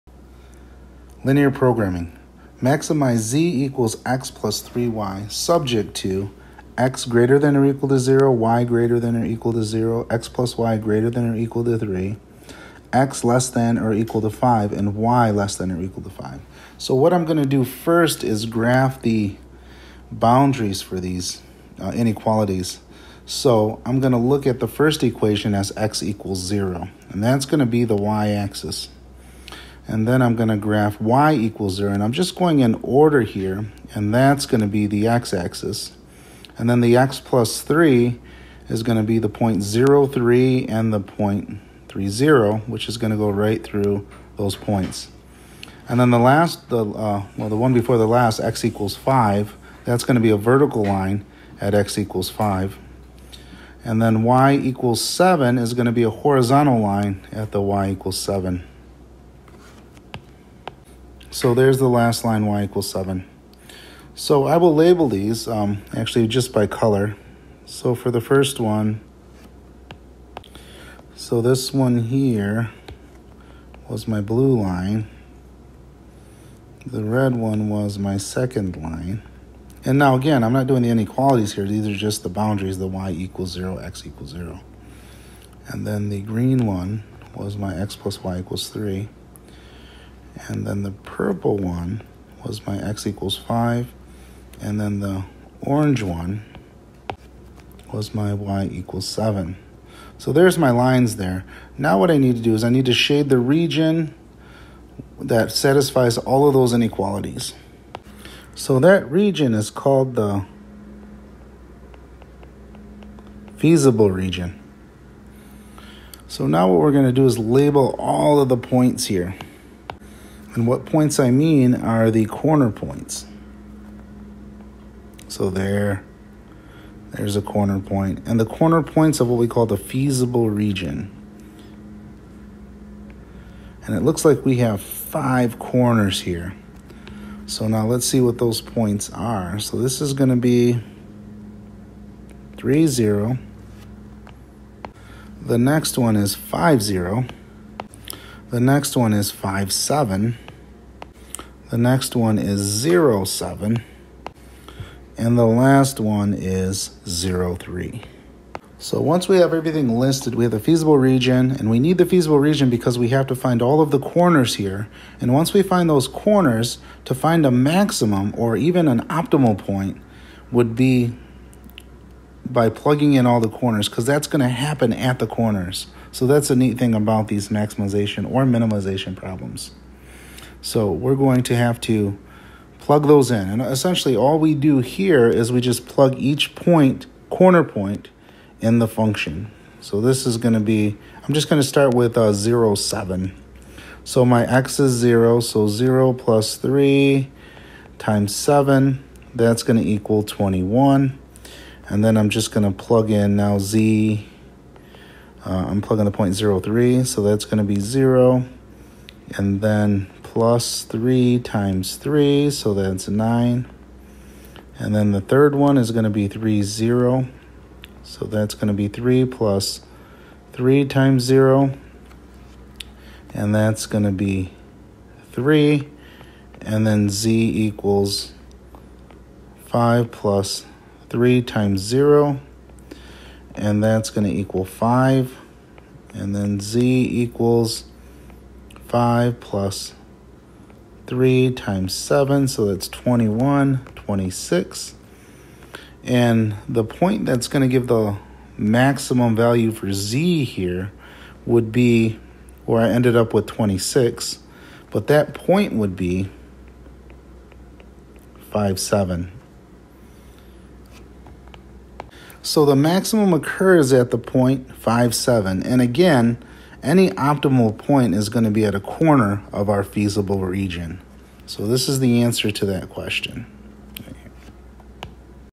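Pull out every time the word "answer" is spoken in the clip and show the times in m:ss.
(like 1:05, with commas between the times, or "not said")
4:32.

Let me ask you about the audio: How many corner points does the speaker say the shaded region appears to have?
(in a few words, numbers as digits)
5.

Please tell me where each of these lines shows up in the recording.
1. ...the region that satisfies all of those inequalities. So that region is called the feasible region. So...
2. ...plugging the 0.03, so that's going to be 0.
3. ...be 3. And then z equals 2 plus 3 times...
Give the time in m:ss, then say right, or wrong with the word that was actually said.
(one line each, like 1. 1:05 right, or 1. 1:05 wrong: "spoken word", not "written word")
1. 1:43 right
2. 3:25 right
3. 3:44 wrong: "5", not "2".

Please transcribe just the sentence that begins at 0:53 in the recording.
And then y equals 7 is going to be a horizontal line at the y equals 7.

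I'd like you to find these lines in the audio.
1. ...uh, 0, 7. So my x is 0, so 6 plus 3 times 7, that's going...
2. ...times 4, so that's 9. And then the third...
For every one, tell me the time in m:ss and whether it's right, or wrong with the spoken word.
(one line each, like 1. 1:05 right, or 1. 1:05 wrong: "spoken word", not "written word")
1. 3:12 wrong: "0", not "6"
2. 3:31 wrong: "3", not "4".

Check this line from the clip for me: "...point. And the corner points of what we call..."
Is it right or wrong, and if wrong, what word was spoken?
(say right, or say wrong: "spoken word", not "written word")
right.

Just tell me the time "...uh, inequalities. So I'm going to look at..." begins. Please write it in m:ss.
0:21.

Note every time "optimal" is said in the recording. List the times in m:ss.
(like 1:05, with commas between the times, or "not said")
2:49, 4:27.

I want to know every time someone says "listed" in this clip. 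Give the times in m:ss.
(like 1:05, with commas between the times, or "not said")
2:39.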